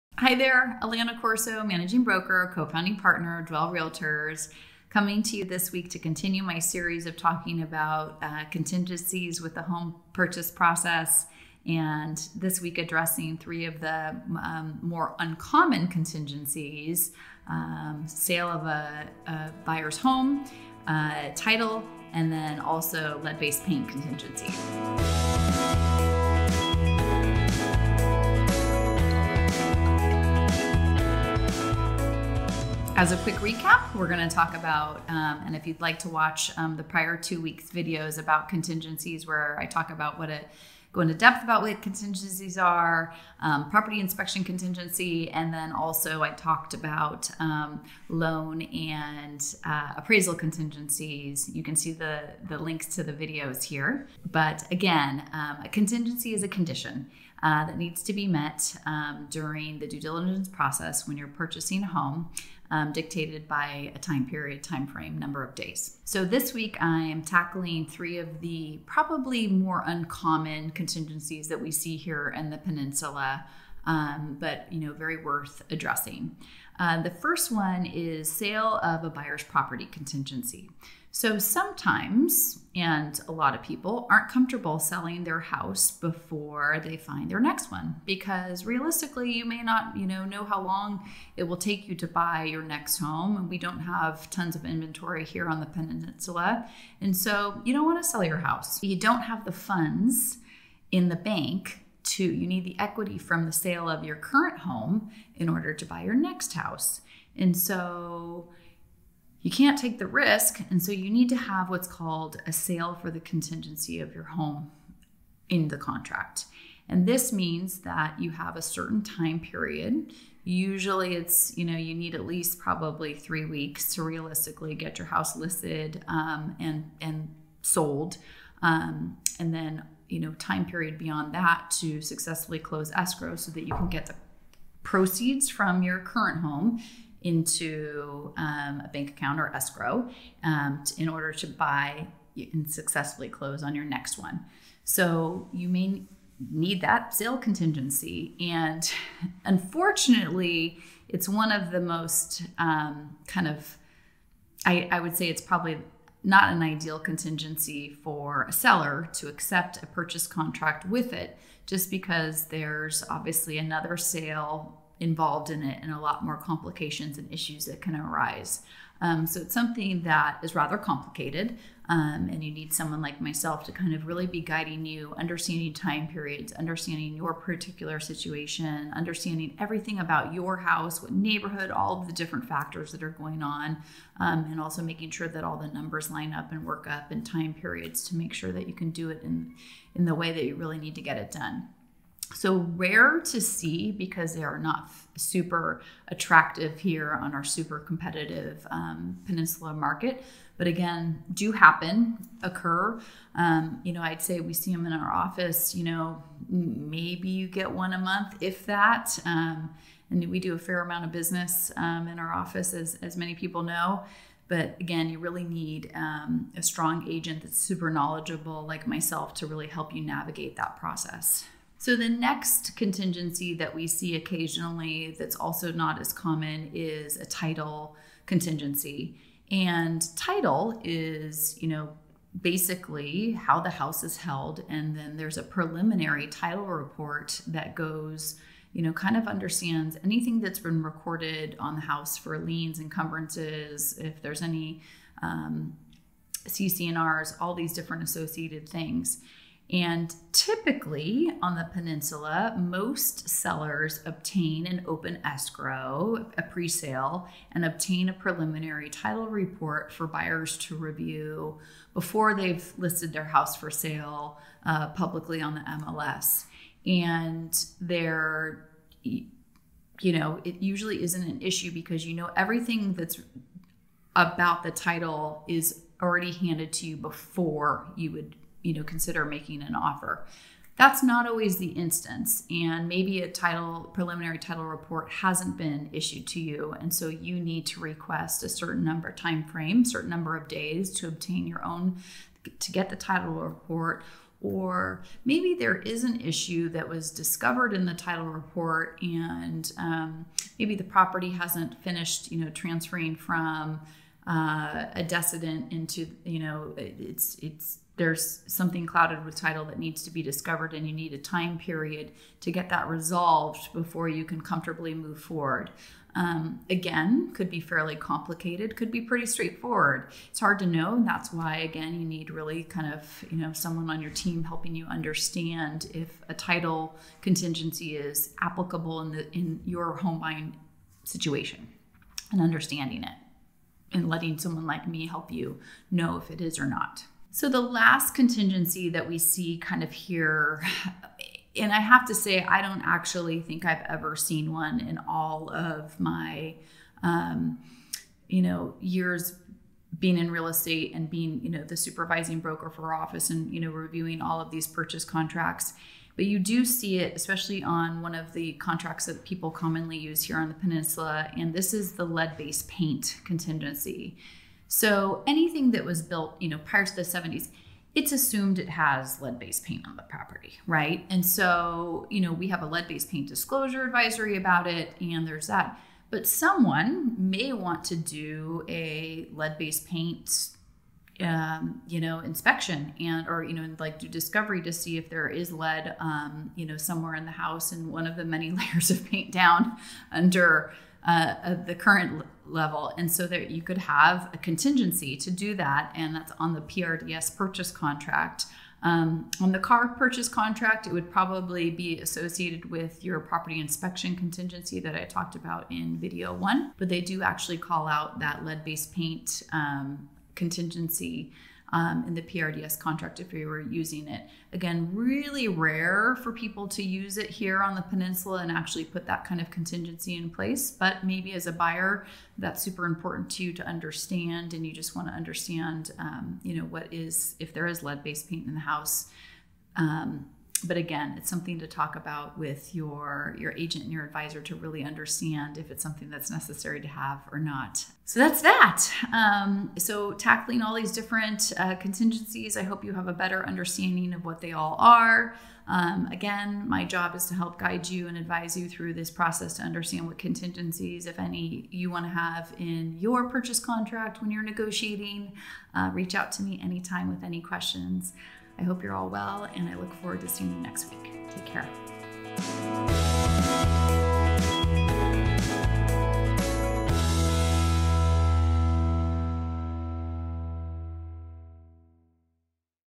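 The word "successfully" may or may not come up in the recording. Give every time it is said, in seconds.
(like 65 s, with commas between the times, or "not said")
132 s, 142 s.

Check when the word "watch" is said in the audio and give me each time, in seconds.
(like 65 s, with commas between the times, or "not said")
36 s.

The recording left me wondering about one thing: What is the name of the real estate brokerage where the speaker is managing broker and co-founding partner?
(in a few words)
Dwell Realtors.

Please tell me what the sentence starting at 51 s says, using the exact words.
You can see the the links to the videos here.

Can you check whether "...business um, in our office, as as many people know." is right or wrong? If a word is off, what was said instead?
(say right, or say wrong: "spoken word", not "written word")
right.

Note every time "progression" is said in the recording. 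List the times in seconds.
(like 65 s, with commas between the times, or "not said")
not said.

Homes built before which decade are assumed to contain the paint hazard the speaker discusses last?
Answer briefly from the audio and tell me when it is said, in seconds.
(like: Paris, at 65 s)
the 70s, at 366 s.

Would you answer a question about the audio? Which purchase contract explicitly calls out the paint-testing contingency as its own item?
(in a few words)
PRDS purchase contract.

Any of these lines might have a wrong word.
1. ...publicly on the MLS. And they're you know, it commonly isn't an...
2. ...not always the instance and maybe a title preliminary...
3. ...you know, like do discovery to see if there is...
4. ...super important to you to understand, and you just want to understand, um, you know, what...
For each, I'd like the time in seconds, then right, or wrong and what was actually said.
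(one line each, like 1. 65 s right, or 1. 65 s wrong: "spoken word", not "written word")
1. 264 s wrong: "usually", not "commonly"
2. 281 s right
3. 383 s right
4. 422 s right.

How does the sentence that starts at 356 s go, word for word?
But you do see it, especially on one of the contracts that people commonly use here on the peninsula.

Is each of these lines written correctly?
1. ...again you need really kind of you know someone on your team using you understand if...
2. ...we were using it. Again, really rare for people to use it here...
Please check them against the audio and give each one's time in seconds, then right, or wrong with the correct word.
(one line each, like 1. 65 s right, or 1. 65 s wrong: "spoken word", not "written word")
1. 321 s wrong: "helping", not "using"
2. 413 s right.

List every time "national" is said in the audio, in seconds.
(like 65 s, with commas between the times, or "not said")
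not said.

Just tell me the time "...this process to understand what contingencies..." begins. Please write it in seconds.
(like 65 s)
448 s.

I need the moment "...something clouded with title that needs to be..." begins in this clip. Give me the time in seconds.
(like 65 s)
308 s.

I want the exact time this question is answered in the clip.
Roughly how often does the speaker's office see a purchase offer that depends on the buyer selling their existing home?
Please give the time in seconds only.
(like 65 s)
207 s.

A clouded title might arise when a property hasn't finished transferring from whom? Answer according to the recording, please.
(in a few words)
a decedent.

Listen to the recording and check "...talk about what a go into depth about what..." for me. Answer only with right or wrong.
right.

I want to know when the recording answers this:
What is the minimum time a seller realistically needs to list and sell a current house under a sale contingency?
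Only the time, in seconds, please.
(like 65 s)
123 s.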